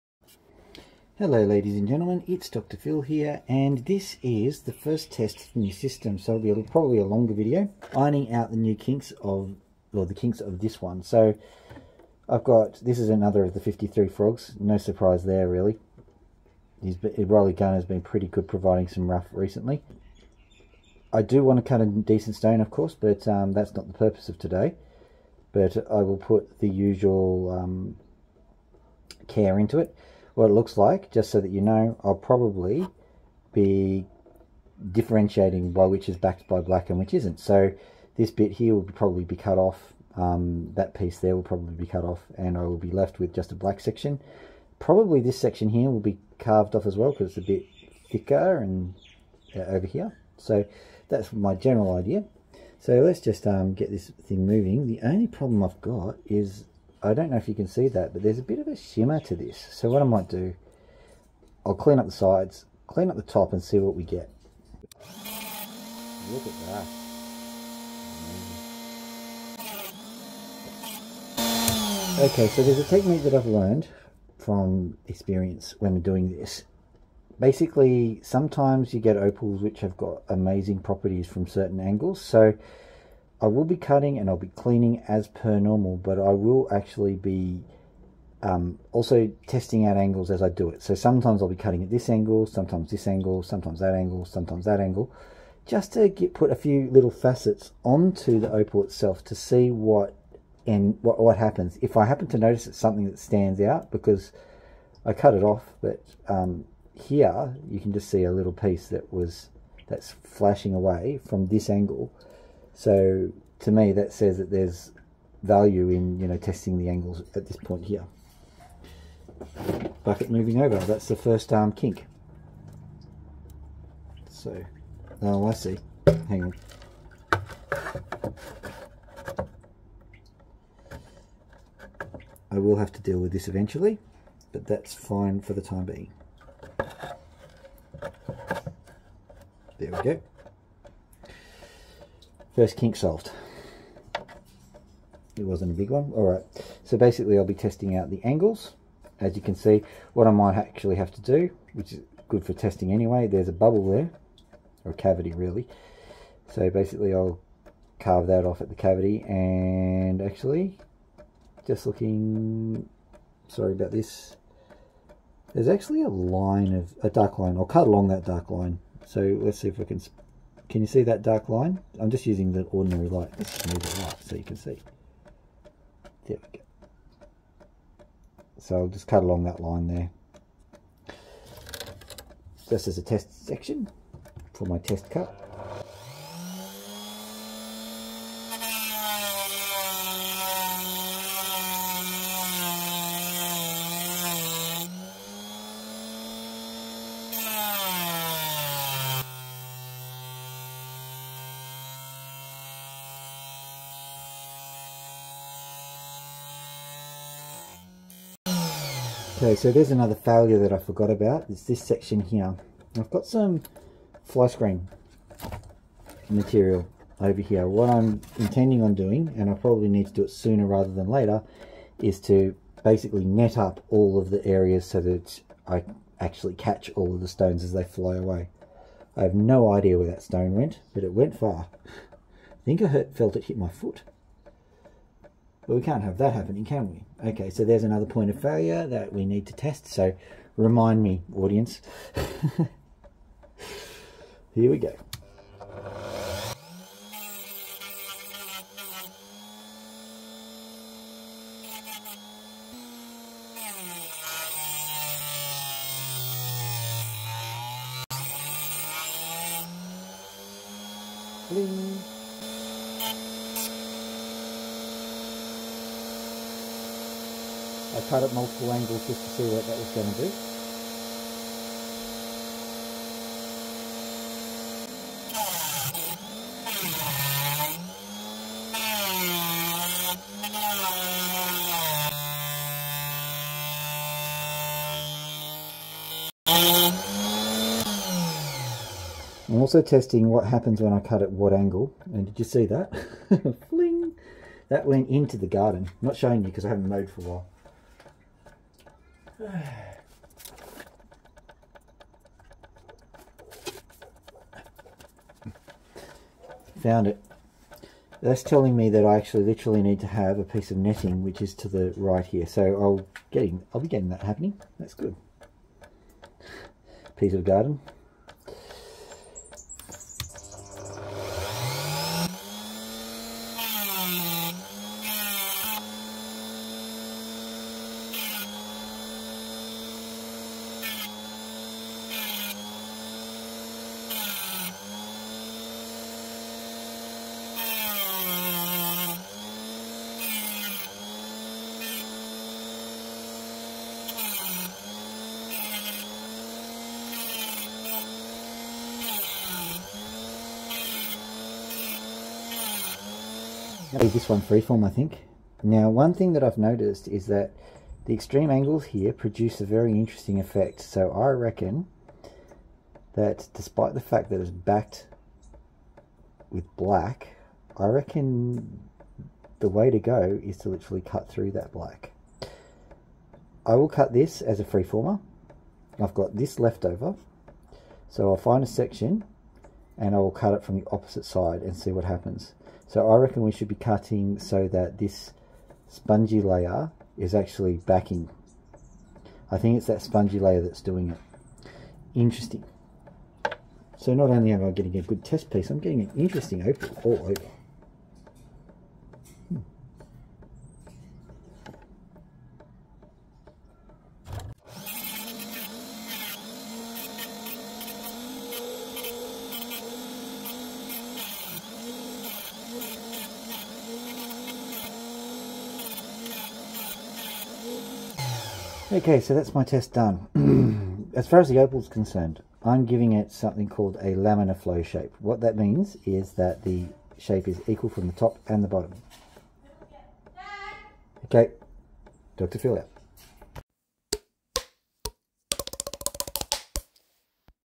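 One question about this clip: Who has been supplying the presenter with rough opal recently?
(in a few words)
Riley.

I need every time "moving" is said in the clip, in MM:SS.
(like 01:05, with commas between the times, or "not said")
00:54, 02:00.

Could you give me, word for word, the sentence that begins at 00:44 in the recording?
Probably this section here will be carved off as well because it's a bit thicker and uh, over here.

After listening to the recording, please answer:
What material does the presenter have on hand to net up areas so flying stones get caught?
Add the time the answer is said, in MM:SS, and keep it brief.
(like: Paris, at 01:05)
Fly screen, at 03:34.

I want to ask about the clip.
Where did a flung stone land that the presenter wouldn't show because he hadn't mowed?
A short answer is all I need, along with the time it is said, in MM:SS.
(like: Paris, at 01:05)
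The garden, at 04:55.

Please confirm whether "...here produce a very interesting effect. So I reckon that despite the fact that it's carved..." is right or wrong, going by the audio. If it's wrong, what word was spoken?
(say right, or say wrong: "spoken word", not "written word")
wrong: "backed", not "carved".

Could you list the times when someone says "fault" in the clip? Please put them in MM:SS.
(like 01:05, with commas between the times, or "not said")
not said.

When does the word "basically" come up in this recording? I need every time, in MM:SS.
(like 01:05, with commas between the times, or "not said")
01:17, 02:26, 02:36, 03:42.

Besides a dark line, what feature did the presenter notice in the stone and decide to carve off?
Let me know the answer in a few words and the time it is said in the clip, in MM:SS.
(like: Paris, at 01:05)
A bubble, at 02:33.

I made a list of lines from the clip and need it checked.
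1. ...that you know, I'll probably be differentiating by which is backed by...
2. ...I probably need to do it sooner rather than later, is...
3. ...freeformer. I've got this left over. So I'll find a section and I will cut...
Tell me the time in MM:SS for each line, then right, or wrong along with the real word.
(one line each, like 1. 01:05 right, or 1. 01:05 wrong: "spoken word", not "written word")
1. 00:31 right
2. 03:39 right
3. 06:14 right.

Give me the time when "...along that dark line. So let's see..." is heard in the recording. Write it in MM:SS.
02:47.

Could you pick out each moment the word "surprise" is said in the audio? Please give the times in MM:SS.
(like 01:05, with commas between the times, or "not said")
00:14.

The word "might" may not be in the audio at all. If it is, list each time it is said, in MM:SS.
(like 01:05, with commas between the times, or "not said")
01:00, 02:30.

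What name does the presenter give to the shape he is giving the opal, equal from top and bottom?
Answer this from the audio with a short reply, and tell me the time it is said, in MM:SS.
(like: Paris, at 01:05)
Laminar flow, at 07:04.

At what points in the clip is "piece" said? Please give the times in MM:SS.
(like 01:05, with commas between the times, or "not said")
00:40, 01:48, 05:10, 05:17, 06:35.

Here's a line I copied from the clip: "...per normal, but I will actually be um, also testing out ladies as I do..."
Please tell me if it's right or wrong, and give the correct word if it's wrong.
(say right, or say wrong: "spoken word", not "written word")
wrong: "angles", not "ladies".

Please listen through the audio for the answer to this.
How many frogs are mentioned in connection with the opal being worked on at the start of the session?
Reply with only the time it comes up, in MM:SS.
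00:13.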